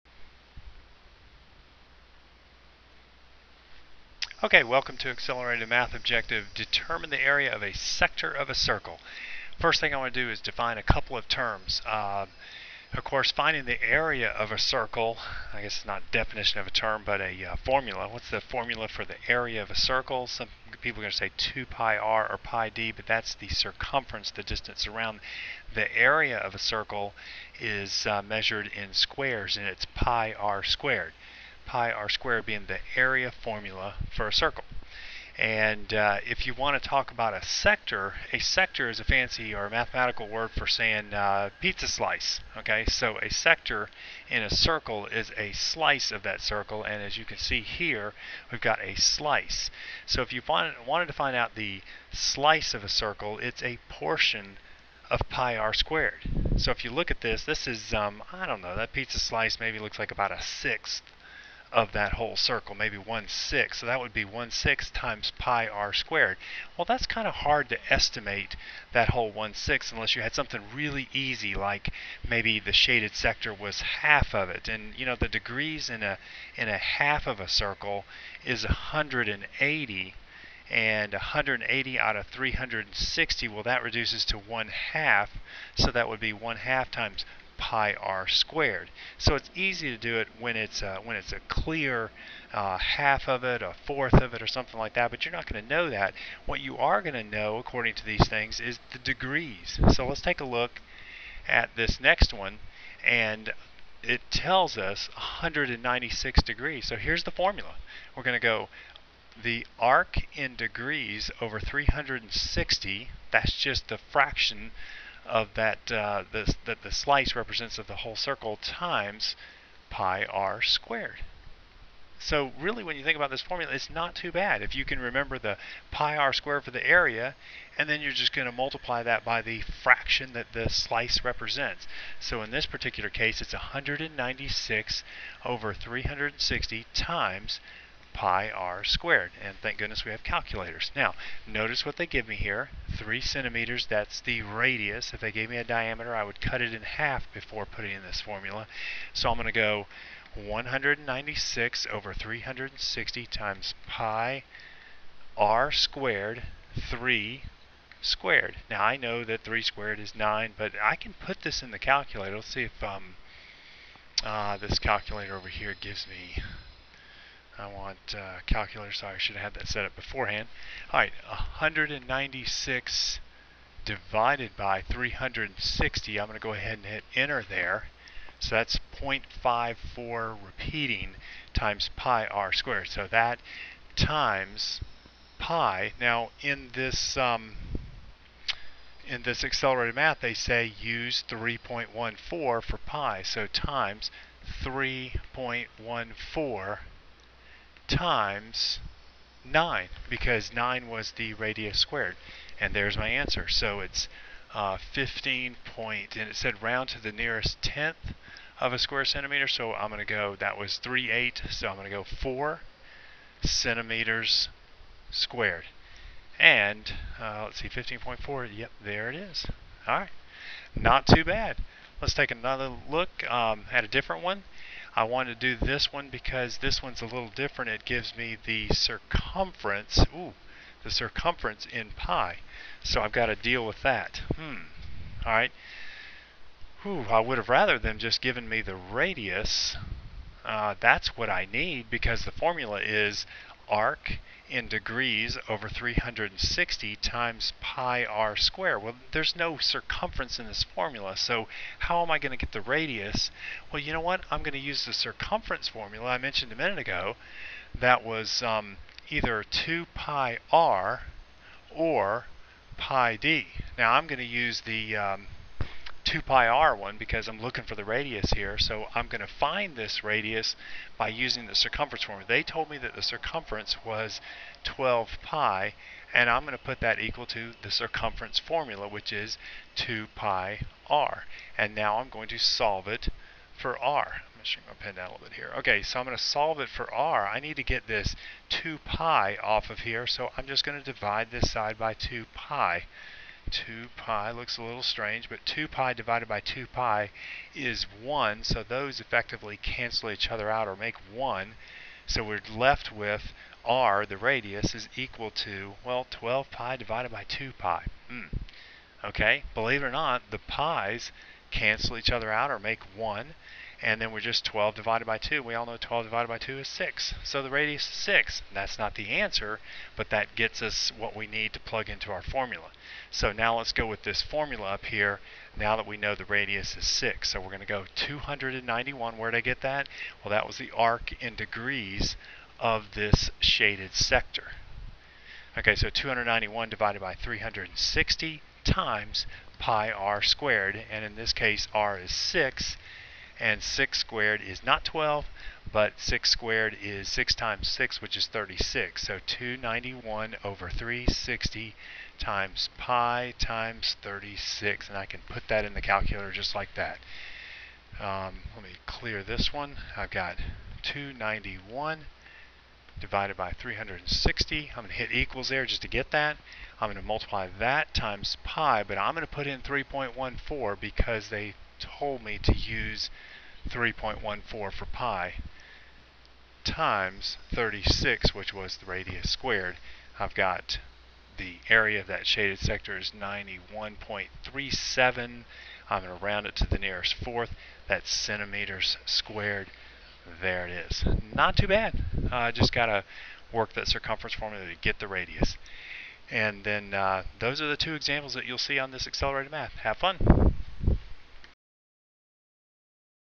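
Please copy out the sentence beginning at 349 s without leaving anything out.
So 291 over 360 times pi times 36.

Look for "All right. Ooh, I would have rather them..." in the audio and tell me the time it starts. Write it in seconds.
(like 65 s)
235 s.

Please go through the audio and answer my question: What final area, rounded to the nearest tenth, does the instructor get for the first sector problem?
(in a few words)
15.4.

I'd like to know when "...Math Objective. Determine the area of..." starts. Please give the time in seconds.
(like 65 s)
5 s.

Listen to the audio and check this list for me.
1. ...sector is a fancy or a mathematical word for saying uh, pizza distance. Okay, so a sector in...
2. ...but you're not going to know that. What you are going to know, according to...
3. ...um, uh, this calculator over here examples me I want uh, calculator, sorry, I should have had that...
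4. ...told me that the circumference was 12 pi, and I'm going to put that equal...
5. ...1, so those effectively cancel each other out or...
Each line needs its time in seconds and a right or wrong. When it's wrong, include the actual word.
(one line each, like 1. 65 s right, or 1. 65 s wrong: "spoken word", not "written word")
1. 38 s wrong: "slice", not "distance"
2. 95 s right
3. 162 s wrong: "gives", not "examples"
4. 272 s right
5. 297 s right.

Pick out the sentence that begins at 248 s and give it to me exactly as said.
Well, there's no circumference in this formula, so how am I going to get the radius?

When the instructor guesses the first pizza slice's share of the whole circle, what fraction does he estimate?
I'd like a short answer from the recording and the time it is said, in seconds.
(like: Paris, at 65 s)
1/6, at 60 s.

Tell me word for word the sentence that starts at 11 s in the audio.
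Uh, of course, finding the area of a circle, I guess it's not definition of a term, but a uh, formula.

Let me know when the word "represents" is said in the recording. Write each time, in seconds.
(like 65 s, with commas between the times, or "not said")
117 s, 131 s.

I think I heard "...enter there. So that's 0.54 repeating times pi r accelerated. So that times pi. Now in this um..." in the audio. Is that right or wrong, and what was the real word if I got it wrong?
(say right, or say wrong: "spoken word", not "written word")
wrong: "squared", not "accelerated".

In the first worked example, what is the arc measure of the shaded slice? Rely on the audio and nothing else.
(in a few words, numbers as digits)
196 degrees.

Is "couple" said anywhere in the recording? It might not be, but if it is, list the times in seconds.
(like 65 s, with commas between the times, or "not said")
10 s.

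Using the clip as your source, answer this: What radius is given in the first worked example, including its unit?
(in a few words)
3 centimeters.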